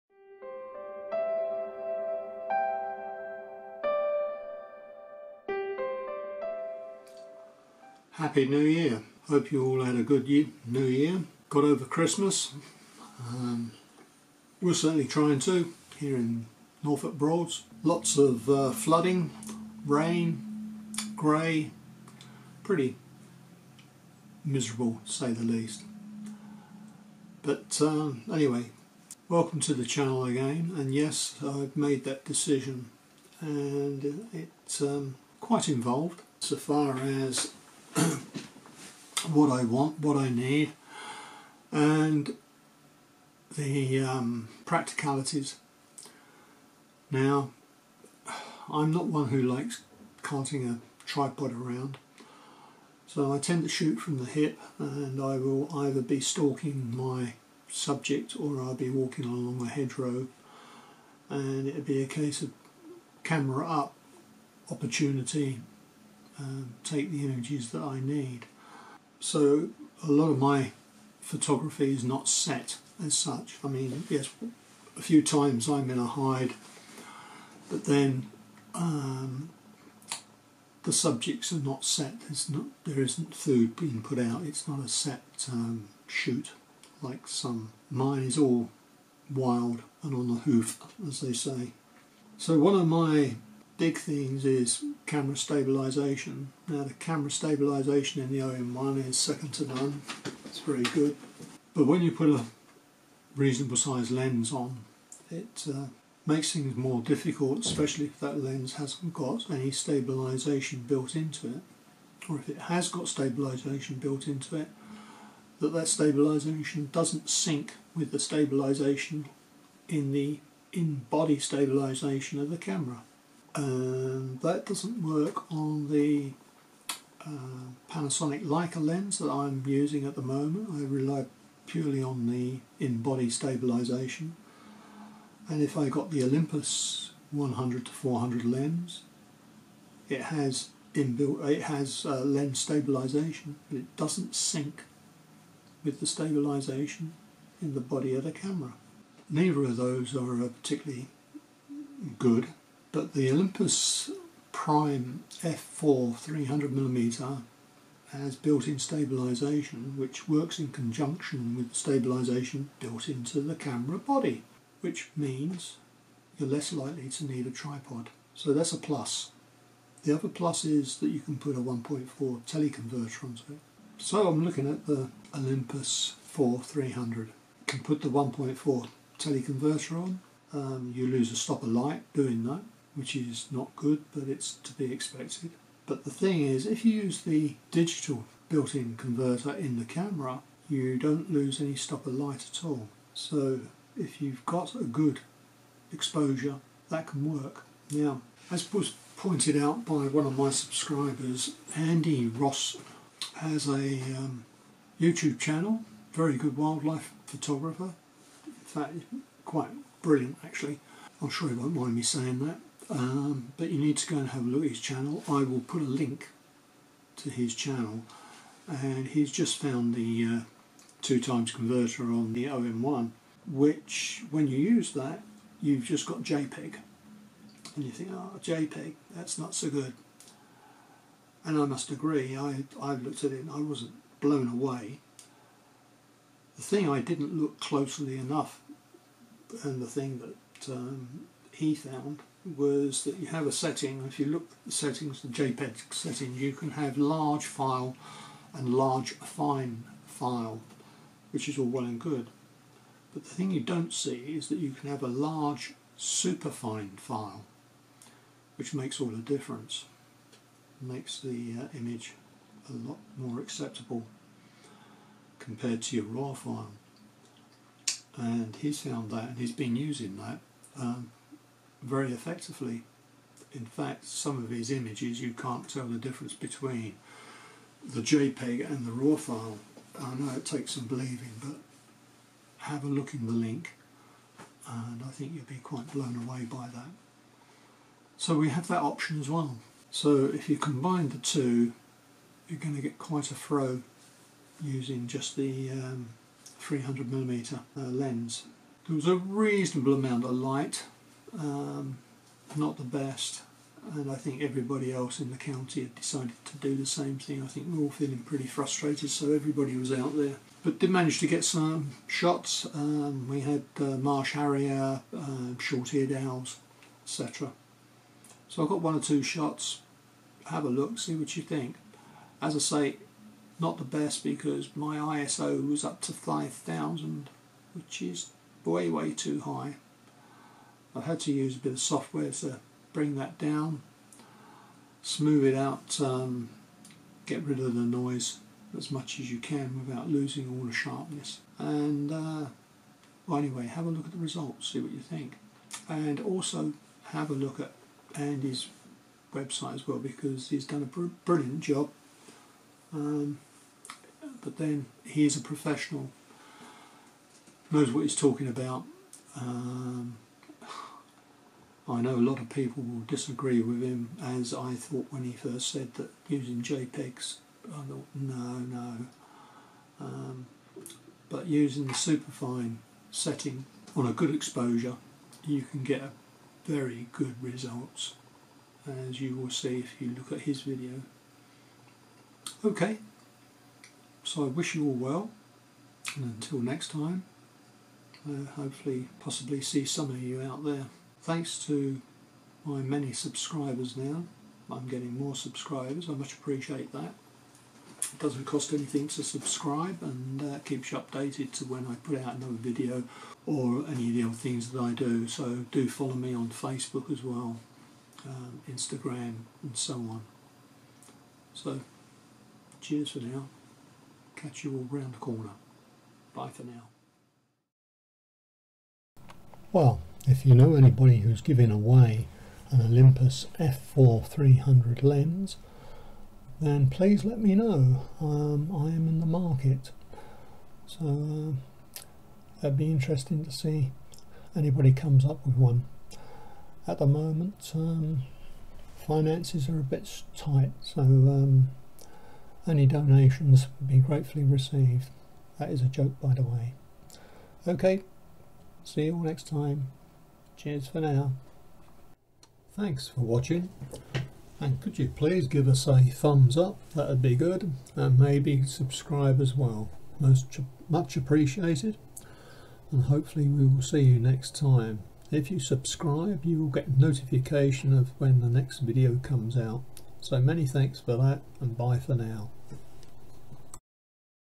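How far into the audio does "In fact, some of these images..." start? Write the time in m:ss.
4:33.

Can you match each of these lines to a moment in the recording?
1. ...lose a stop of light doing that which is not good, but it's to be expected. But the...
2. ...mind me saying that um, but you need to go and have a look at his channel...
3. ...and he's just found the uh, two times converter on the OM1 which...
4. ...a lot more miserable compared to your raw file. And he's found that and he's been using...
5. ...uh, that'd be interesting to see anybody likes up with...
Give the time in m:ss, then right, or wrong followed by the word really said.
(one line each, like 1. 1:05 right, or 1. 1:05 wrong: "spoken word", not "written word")
1. 3:01 right
2. 3:31 right
3. 3:38 right
4. 4:22 wrong: "acceptable", not "miserable"
5. 7:11 wrong: "comes", not "likes".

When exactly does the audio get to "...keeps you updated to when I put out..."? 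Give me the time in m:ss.
6:40.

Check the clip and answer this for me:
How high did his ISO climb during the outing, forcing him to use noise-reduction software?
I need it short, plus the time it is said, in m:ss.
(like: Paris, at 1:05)
5,000, at 5:26.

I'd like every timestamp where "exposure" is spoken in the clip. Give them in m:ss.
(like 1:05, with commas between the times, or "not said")
3:15, 6:14.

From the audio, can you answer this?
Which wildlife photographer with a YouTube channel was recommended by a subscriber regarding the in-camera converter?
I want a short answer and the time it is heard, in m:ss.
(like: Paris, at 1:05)
Andy Rouse, at 3:21.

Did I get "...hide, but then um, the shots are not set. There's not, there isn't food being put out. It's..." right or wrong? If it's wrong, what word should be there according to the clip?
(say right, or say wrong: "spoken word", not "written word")
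wrong: "subjects", not "shots".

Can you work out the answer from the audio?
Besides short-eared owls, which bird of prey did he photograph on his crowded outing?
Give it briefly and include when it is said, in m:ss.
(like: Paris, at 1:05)
marsh harrier, at 5:13.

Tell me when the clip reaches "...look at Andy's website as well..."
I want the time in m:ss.
5:47.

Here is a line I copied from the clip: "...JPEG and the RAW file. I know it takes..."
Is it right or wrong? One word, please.
right.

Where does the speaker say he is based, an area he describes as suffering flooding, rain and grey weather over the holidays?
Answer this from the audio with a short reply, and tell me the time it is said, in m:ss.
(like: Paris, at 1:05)
Norfolk Broads, at 0:16.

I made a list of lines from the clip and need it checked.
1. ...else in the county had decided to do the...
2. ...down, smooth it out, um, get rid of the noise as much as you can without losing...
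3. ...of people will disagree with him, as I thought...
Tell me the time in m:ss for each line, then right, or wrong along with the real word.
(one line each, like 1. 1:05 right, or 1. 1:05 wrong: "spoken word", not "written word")
1. 5:04 right
2. 5:33 right
3. 6:02 right.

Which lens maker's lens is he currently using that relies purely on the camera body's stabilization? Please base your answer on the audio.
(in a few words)
Panasonic Leica.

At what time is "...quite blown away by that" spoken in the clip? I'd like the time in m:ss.
4:45.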